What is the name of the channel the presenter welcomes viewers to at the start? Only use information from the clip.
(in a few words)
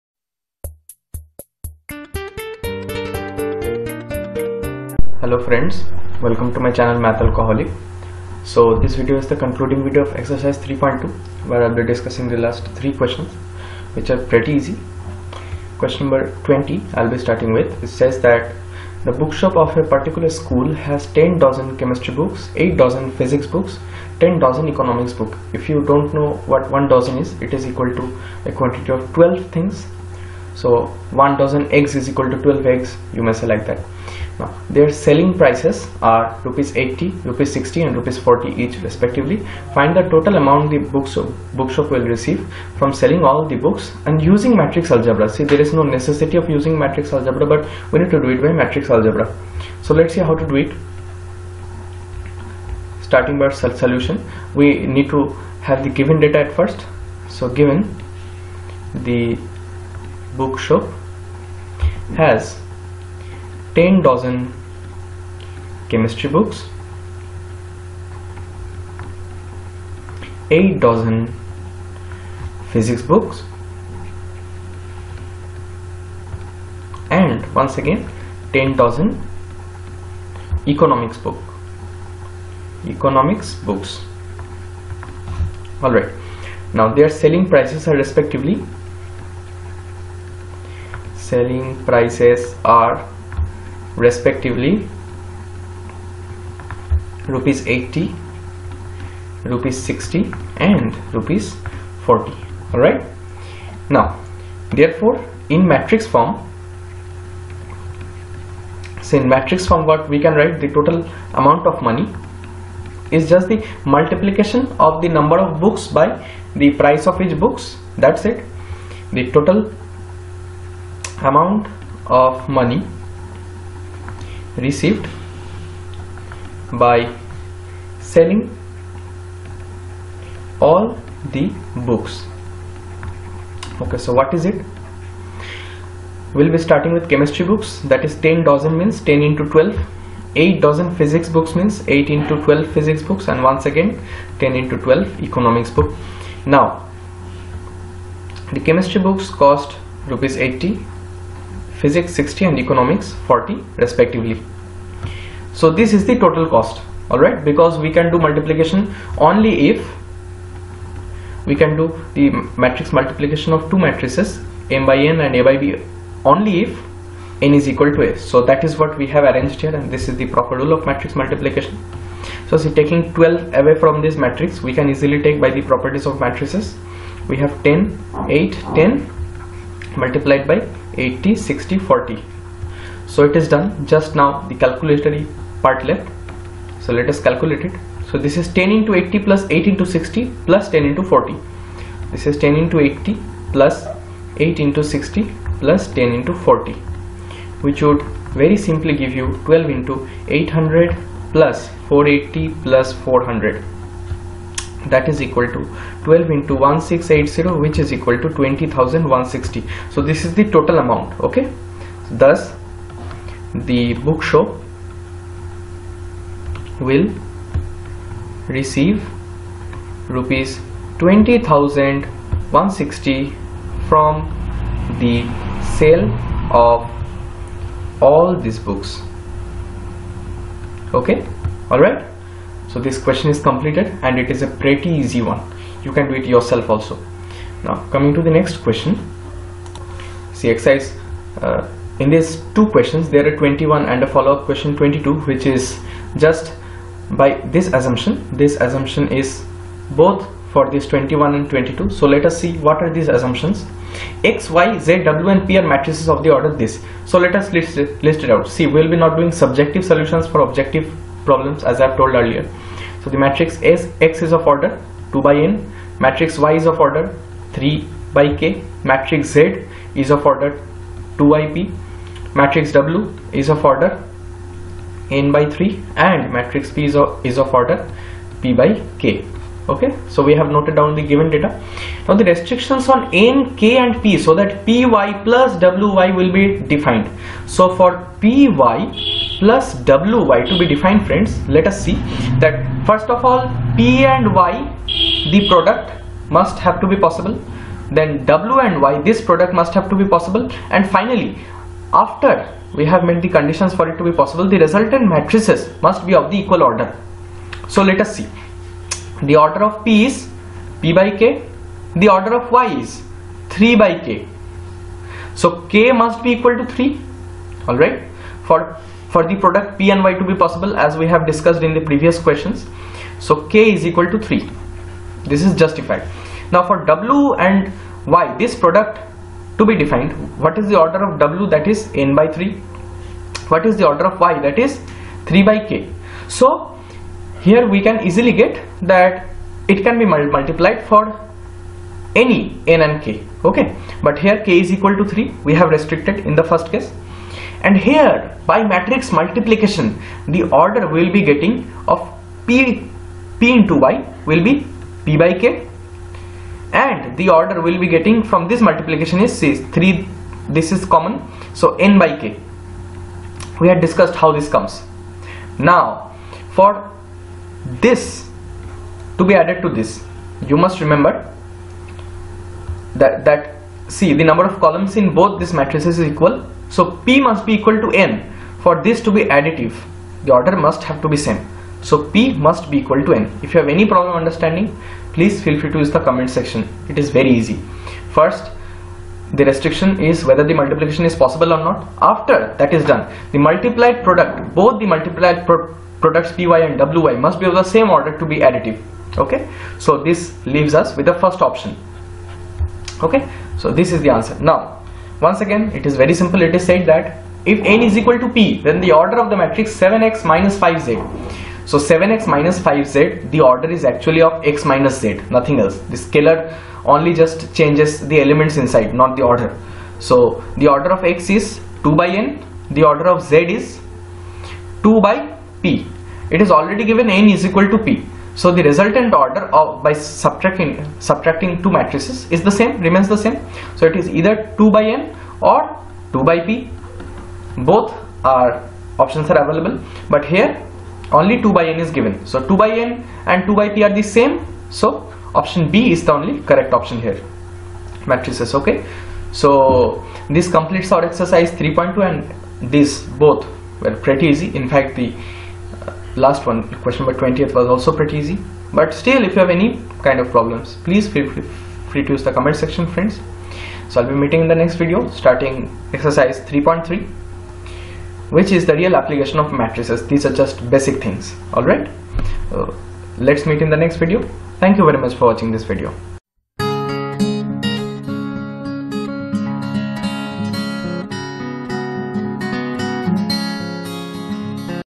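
Math Alcoholic.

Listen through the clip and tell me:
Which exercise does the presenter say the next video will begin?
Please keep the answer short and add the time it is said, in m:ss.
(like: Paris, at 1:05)
Exercise 3.3, at 7:45.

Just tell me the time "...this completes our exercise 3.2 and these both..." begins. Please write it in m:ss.
7:30.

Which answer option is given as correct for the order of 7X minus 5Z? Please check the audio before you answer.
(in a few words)
Option B.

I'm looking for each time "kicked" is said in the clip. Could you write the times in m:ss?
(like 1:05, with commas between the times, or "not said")
not said.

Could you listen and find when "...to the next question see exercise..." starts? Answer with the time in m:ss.
3:58.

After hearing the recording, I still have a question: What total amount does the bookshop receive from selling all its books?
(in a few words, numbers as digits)
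Rs 20160.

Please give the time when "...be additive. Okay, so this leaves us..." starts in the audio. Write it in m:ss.
6:38.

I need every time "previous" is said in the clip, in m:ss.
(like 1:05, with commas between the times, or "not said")
5:21.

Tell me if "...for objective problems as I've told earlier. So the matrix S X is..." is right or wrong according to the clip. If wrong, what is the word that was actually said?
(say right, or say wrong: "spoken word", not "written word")
right.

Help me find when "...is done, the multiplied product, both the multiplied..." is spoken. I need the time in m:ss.
6:32.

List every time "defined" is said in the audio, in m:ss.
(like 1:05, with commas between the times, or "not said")
4:46, 4:50, 5:29.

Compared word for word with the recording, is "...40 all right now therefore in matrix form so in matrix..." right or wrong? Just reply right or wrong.
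right.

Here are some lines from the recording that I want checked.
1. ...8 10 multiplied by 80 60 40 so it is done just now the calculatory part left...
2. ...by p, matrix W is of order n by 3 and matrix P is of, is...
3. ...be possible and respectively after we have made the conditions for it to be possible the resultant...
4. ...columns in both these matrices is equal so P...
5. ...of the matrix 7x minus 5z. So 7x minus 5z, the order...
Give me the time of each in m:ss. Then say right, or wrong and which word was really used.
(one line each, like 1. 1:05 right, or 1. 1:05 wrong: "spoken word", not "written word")
1. 2:58 right
2. 4:31 right
3. 5:00 wrong: "finally", not "respectively"
4. 6:14 right
5. 6:49 right.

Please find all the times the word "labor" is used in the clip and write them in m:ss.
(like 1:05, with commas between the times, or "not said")
not said.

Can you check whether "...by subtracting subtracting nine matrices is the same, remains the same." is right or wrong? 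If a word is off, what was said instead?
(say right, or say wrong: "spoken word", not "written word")
wrong: "two", not "nine".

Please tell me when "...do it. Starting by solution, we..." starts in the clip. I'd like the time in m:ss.
0:50.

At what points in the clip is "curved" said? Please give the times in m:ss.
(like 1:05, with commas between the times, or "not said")
not said.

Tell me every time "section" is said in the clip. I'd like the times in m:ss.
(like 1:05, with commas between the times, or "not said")
6:26, 7:42.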